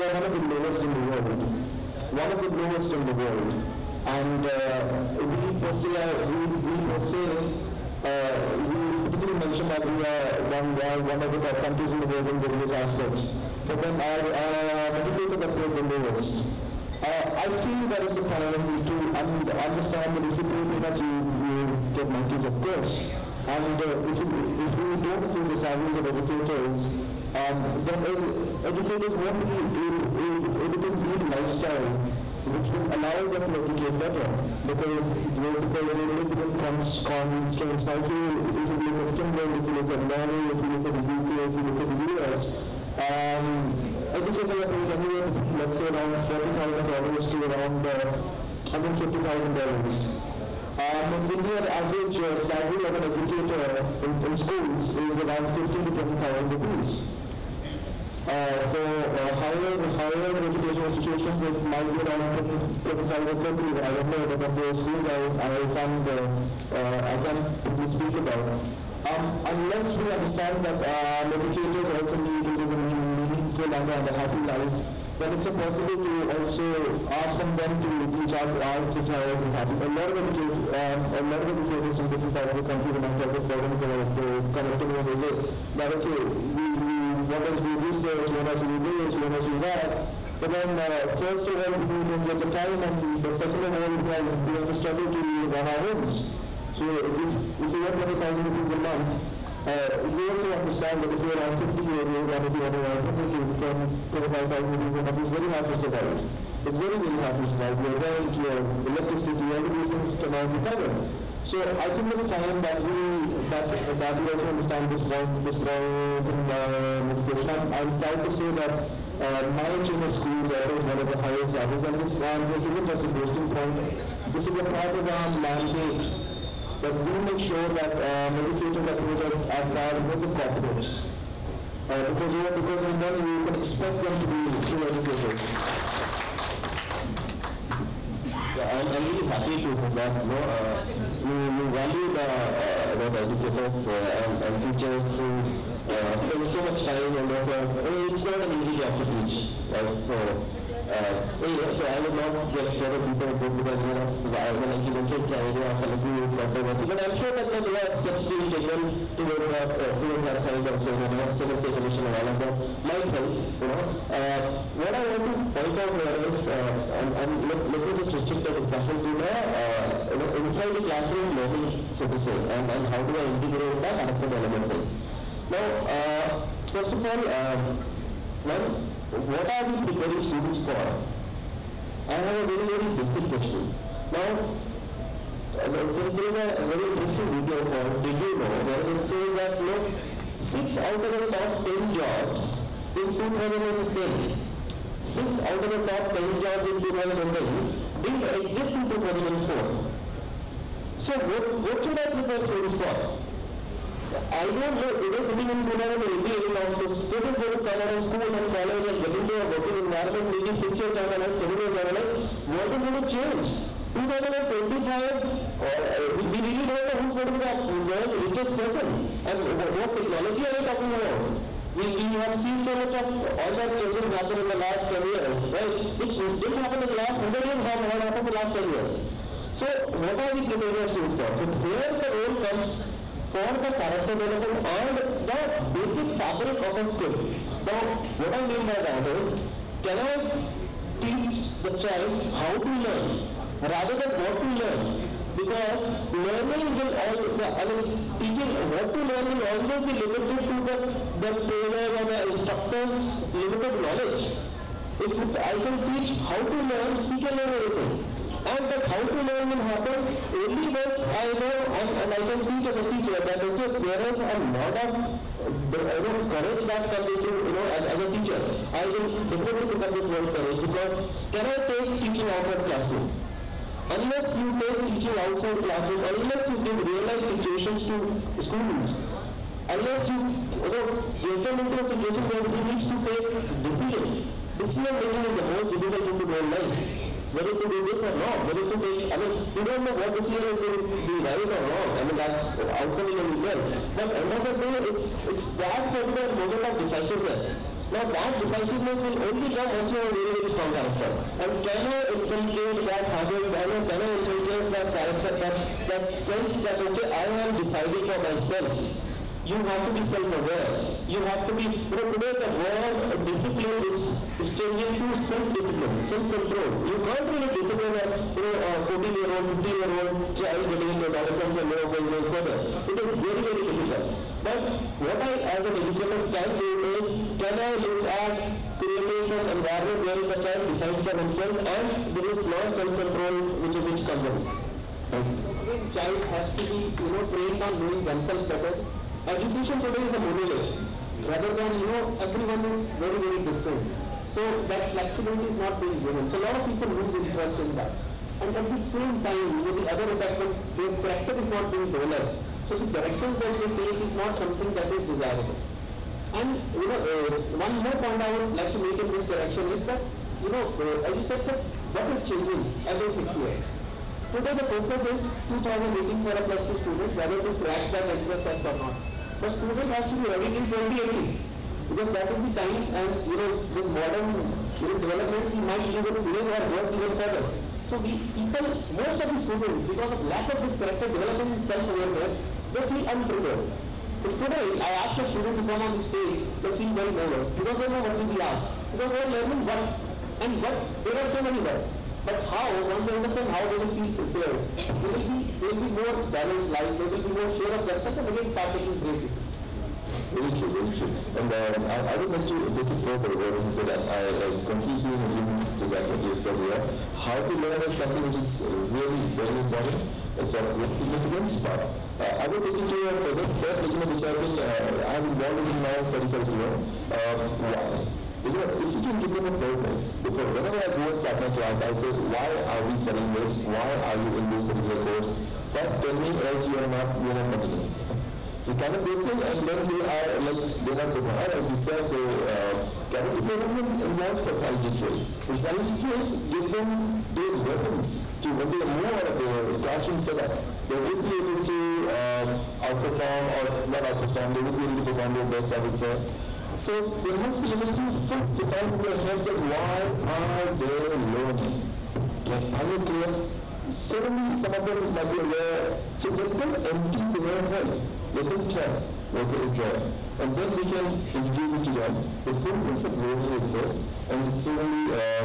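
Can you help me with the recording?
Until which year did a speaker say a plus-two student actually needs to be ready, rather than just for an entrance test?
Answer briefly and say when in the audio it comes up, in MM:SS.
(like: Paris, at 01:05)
2080, at 06:10.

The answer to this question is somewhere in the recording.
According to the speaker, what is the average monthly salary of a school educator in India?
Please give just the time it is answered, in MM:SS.
00:55.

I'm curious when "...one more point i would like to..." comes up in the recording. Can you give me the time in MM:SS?
05:57.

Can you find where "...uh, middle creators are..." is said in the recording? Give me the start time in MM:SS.
02:08.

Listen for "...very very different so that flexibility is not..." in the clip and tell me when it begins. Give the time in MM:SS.
05:42.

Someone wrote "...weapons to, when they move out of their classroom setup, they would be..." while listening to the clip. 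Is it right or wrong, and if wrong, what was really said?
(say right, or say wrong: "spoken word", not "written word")
right.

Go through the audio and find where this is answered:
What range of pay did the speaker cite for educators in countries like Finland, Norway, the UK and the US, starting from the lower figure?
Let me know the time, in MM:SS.
00:46.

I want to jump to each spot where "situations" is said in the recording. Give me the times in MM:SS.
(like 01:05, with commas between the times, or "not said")
04:37, 04:41.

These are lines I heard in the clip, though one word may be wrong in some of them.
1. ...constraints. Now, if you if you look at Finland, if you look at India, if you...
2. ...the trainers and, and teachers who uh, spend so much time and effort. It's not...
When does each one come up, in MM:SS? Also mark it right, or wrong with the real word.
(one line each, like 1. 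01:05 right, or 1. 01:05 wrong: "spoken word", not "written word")
1. 00:36 wrong: "Norway", not "India"
2. 02:23 wrong: "educators", not "trainers".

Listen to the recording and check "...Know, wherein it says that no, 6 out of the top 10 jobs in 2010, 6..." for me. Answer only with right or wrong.
right.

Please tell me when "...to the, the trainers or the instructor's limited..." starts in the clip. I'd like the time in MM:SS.
04:10.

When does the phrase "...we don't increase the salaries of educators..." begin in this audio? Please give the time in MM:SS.
00:24.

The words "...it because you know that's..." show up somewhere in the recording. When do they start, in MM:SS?
02:33.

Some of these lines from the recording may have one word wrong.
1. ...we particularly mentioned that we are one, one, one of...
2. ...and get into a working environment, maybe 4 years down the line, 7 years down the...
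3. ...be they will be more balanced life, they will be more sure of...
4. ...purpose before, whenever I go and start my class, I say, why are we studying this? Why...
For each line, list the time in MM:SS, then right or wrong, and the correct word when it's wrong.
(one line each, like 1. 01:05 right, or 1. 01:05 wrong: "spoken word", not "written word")
1. 00:08 right
2. 03:28 wrong: "6", not "4"
3. 06:35 right
4. 06:59 right.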